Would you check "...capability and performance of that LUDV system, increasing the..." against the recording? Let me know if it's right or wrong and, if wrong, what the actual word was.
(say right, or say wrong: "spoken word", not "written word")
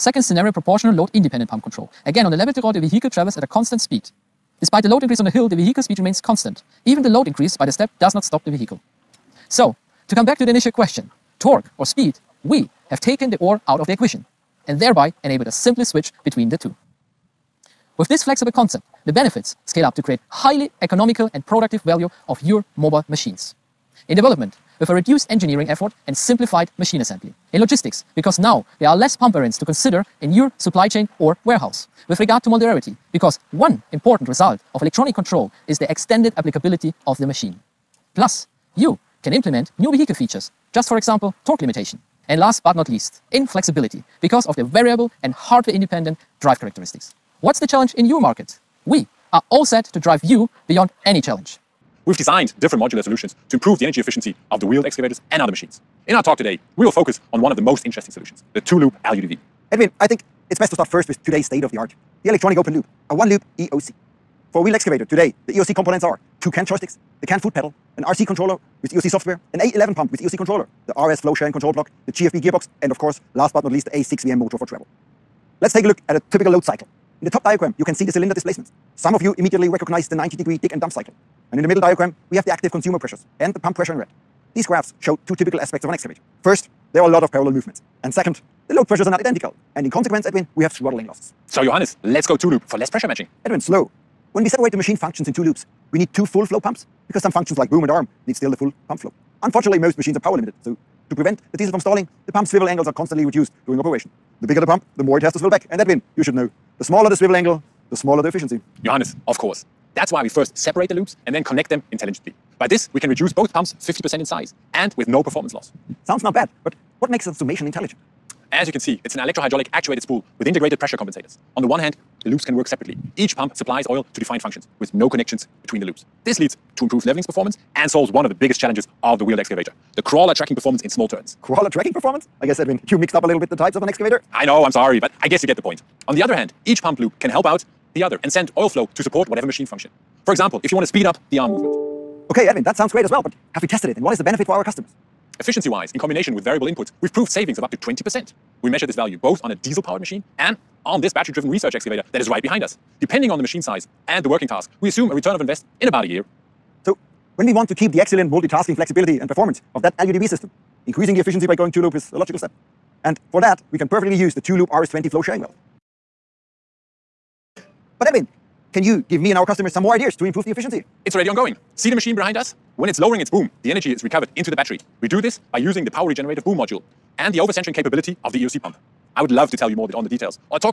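wrong: "flexibility", not "capability".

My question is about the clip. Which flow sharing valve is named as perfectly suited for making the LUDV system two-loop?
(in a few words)
RS20.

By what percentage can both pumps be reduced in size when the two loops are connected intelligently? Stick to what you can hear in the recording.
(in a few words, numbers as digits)
50%.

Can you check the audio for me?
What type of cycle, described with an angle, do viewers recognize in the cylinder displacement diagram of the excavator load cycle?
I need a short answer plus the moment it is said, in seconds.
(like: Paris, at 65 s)
90 degree dig and dump, at 80 s.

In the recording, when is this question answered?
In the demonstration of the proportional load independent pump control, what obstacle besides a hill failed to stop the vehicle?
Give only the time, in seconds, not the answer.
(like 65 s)
7 s.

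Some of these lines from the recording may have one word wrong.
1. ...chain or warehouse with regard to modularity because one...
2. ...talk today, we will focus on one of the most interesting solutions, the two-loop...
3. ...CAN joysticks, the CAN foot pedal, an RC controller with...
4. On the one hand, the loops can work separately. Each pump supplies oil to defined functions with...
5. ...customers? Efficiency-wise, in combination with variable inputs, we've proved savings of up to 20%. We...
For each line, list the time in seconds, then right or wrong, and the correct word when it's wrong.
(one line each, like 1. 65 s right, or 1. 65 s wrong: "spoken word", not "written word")
1. 30 s right
2. 56 s right
3. 66 s right
4. 121 s right
5. 144 s right.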